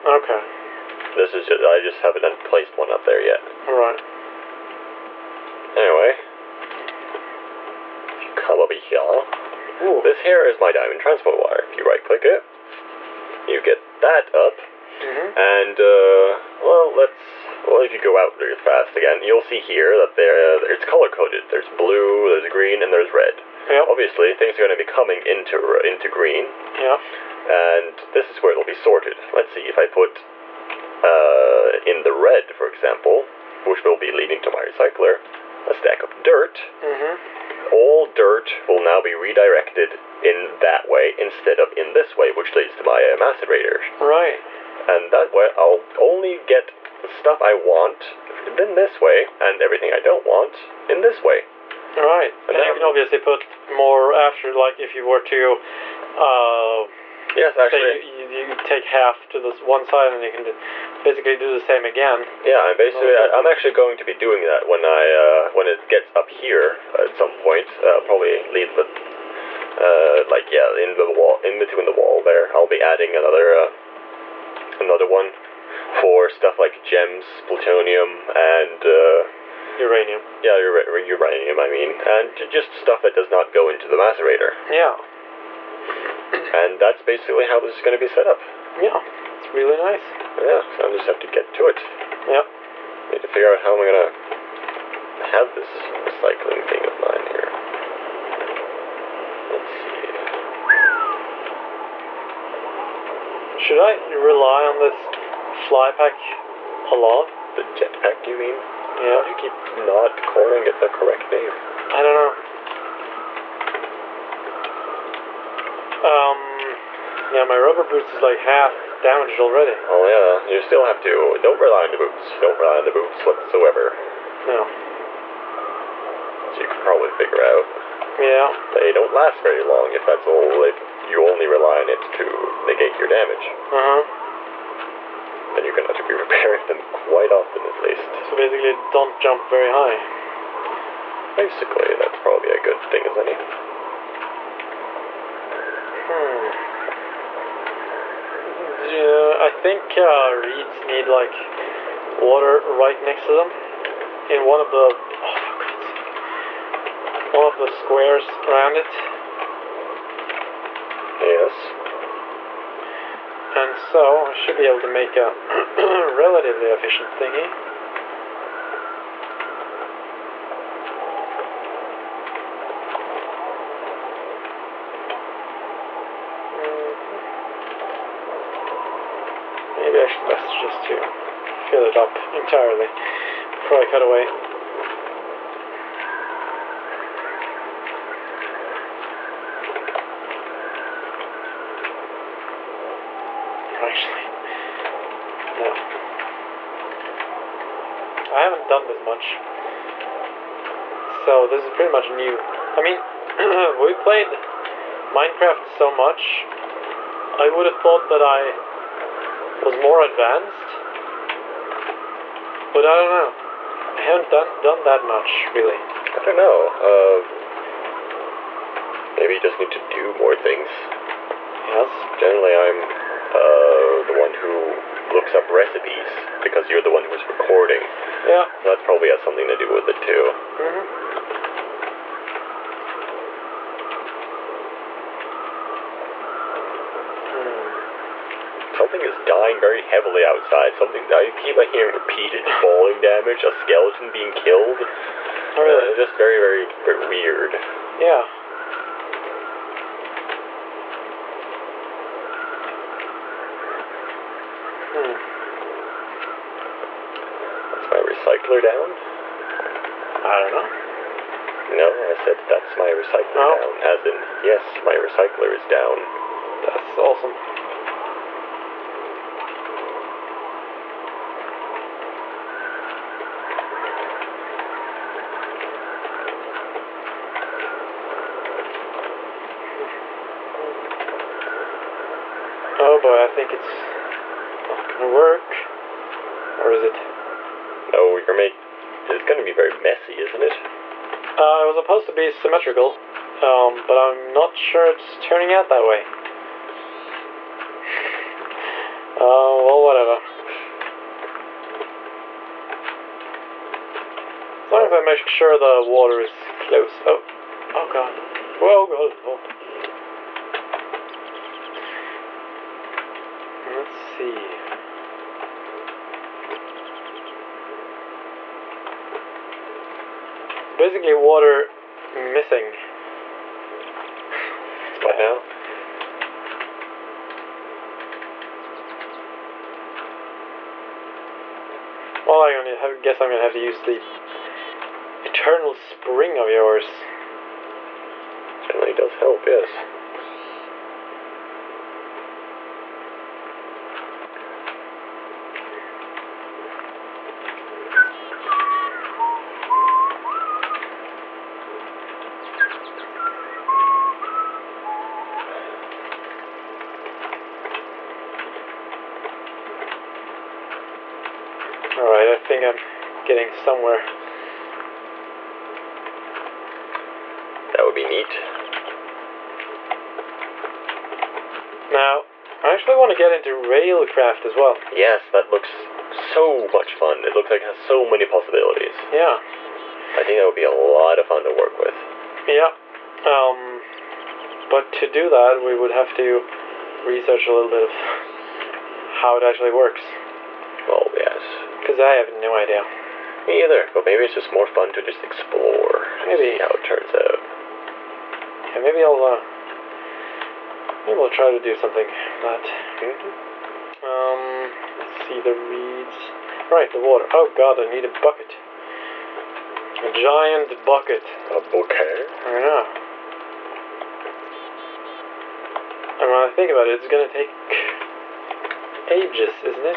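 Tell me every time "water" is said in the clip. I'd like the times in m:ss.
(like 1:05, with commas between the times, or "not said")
2:32, 5:05, 5:21, 6:46.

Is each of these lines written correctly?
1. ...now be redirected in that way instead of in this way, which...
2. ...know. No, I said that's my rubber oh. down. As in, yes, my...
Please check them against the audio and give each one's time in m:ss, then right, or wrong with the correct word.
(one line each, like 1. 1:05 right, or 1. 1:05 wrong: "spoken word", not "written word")
1. 0:38 right
2. 4:20 wrong: "recycler", not "rubber".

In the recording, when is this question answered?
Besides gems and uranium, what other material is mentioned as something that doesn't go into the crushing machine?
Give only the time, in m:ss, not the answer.
1:17.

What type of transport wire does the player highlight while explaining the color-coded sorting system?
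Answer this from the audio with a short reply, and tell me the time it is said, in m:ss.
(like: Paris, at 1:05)
Diamond, at 0:10.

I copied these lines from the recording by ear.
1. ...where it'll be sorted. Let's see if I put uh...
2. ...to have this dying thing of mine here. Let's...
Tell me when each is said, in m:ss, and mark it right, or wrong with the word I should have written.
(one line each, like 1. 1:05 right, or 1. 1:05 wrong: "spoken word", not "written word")
1. 0:28 right
2. 1:34 wrong: "recycling", not "dying".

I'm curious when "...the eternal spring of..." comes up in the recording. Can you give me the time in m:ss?
5:33.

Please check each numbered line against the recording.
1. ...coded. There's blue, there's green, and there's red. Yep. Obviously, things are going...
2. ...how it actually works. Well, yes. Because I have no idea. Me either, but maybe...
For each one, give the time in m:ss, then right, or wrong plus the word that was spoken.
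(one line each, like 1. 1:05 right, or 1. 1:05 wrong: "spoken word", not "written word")
1. 0:21 right
2. 6:29 right.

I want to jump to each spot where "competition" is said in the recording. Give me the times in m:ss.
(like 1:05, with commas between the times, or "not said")
not said.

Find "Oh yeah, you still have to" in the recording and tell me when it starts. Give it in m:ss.
1:59.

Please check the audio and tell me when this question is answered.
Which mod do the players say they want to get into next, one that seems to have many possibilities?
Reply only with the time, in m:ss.
6:13.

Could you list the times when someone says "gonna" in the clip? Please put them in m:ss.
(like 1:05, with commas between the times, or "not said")
4:44, 5:33, 6:57.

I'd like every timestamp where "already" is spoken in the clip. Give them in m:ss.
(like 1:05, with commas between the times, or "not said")
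1:59.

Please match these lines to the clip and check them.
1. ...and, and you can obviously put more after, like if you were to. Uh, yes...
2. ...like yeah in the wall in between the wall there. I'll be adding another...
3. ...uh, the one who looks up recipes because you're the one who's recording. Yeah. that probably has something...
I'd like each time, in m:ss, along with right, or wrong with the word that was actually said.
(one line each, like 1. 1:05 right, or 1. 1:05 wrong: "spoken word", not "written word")
1. 0:52 right
2. 1:10 right
3. 3:43 right.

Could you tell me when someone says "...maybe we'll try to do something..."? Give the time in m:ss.
6:41.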